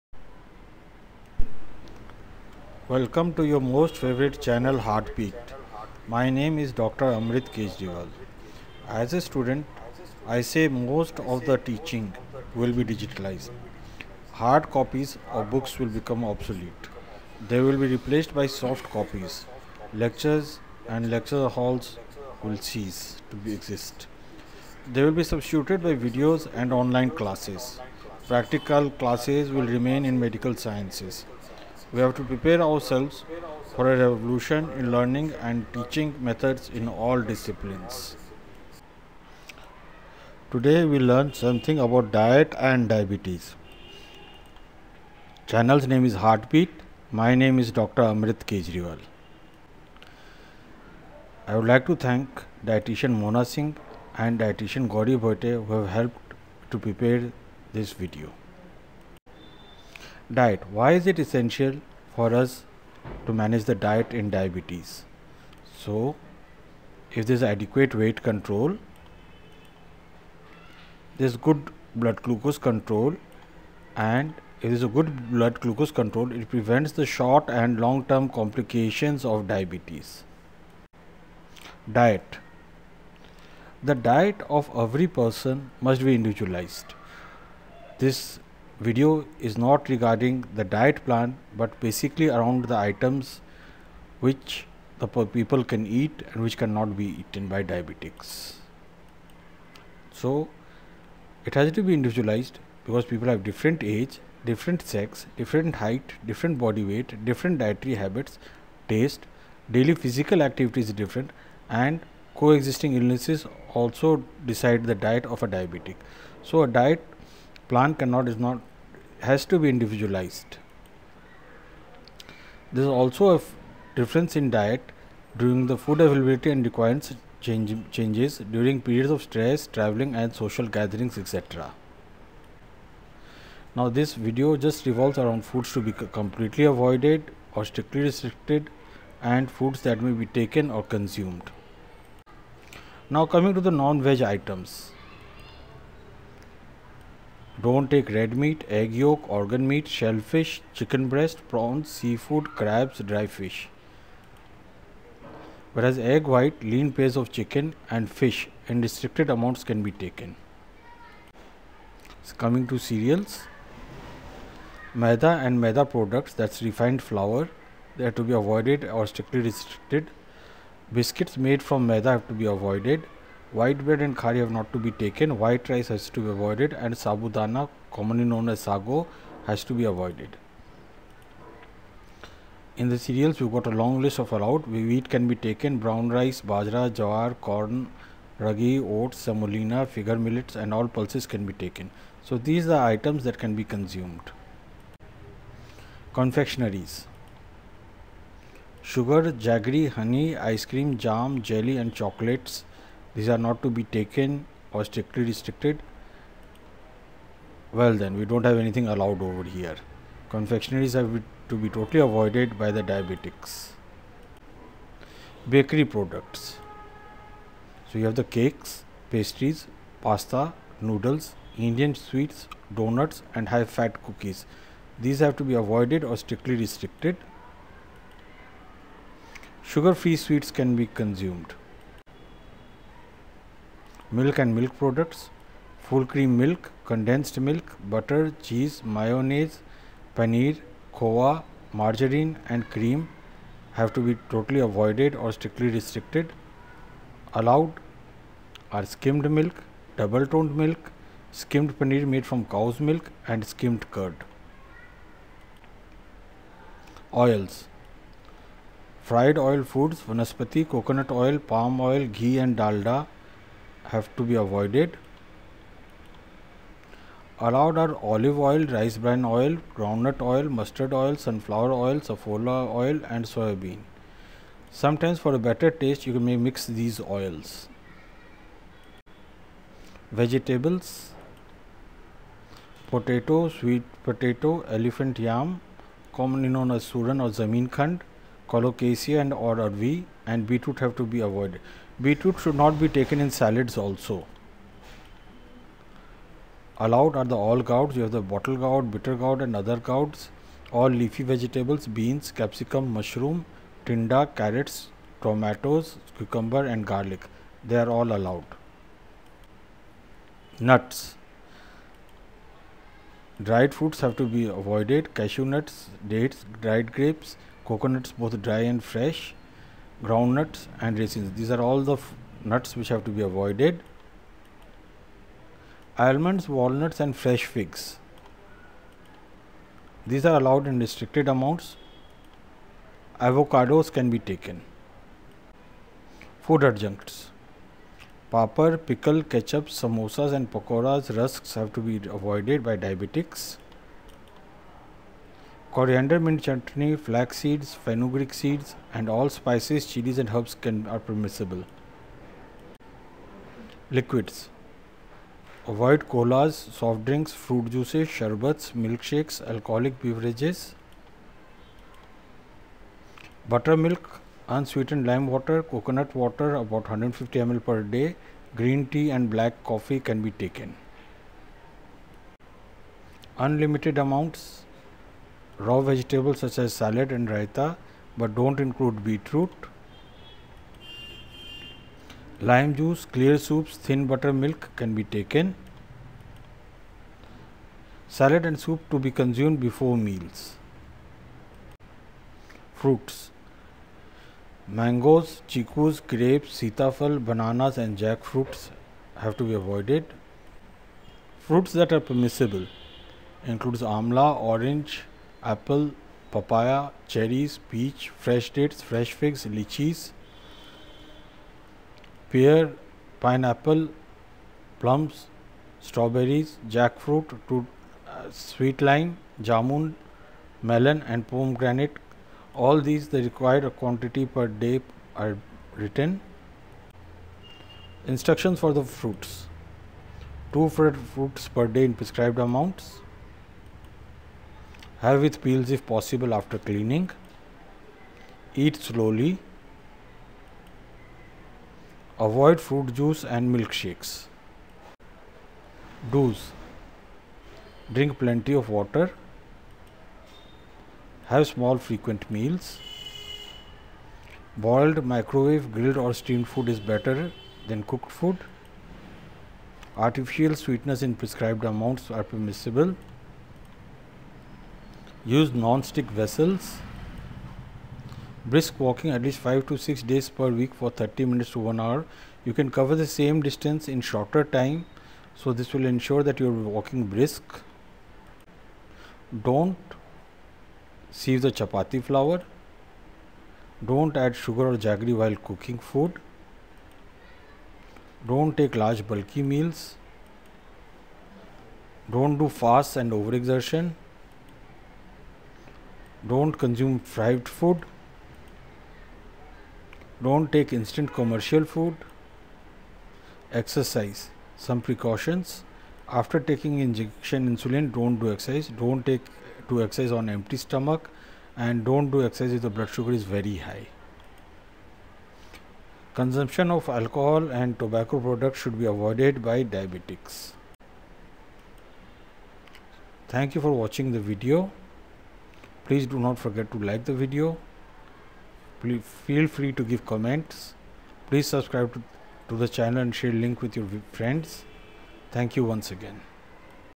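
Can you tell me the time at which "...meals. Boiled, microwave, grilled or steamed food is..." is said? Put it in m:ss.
7:32.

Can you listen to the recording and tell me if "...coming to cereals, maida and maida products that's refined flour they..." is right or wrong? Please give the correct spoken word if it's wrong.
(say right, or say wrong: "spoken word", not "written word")
right.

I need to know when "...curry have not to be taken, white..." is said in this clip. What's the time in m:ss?
2:54.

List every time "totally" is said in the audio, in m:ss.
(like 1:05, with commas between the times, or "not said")
3:31, 4:04.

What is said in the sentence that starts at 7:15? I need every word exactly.
Have with peels if possible after cleaning.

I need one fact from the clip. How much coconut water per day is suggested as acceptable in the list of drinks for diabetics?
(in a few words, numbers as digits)
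150 ml.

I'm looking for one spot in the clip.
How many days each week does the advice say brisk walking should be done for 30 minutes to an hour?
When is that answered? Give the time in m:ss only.
7:49.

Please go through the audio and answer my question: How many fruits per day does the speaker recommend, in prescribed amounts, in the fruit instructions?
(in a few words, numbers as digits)
2.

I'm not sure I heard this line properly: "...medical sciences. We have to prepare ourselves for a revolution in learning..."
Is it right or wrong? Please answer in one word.
right.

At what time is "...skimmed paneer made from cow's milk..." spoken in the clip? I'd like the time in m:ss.
4:11.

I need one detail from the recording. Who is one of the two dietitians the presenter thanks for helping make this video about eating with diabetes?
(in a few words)
Mona Singh.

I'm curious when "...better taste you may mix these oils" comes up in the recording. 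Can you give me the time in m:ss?
4:35.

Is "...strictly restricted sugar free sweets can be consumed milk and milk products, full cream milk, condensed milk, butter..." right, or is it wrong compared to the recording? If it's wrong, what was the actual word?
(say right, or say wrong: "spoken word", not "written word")
right.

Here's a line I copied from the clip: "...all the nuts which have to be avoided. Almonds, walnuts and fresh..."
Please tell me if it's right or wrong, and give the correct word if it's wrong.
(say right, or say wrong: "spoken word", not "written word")
right.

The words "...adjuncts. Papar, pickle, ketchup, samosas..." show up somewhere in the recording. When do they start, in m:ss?
5:36.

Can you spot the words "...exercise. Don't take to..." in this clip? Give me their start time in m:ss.
8:28.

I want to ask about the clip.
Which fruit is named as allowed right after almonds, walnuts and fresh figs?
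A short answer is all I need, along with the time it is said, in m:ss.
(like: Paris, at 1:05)
avocados, at 5:33.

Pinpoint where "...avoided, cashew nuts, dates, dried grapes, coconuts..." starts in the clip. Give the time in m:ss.
5:14.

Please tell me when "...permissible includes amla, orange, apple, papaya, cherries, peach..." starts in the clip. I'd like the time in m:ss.
6:41.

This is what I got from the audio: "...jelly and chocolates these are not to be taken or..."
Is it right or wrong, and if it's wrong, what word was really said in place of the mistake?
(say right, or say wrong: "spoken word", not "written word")
right.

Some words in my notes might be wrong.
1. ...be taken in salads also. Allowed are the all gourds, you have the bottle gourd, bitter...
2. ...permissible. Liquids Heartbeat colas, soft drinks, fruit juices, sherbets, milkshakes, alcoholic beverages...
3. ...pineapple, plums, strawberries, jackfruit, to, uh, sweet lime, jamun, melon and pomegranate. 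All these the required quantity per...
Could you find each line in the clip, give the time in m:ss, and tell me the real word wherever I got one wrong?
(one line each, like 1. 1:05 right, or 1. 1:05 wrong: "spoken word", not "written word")
1. 4:52 right
2. 5:50 wrong: "Avoid", not "Heartbeat"
3. 6:53 right.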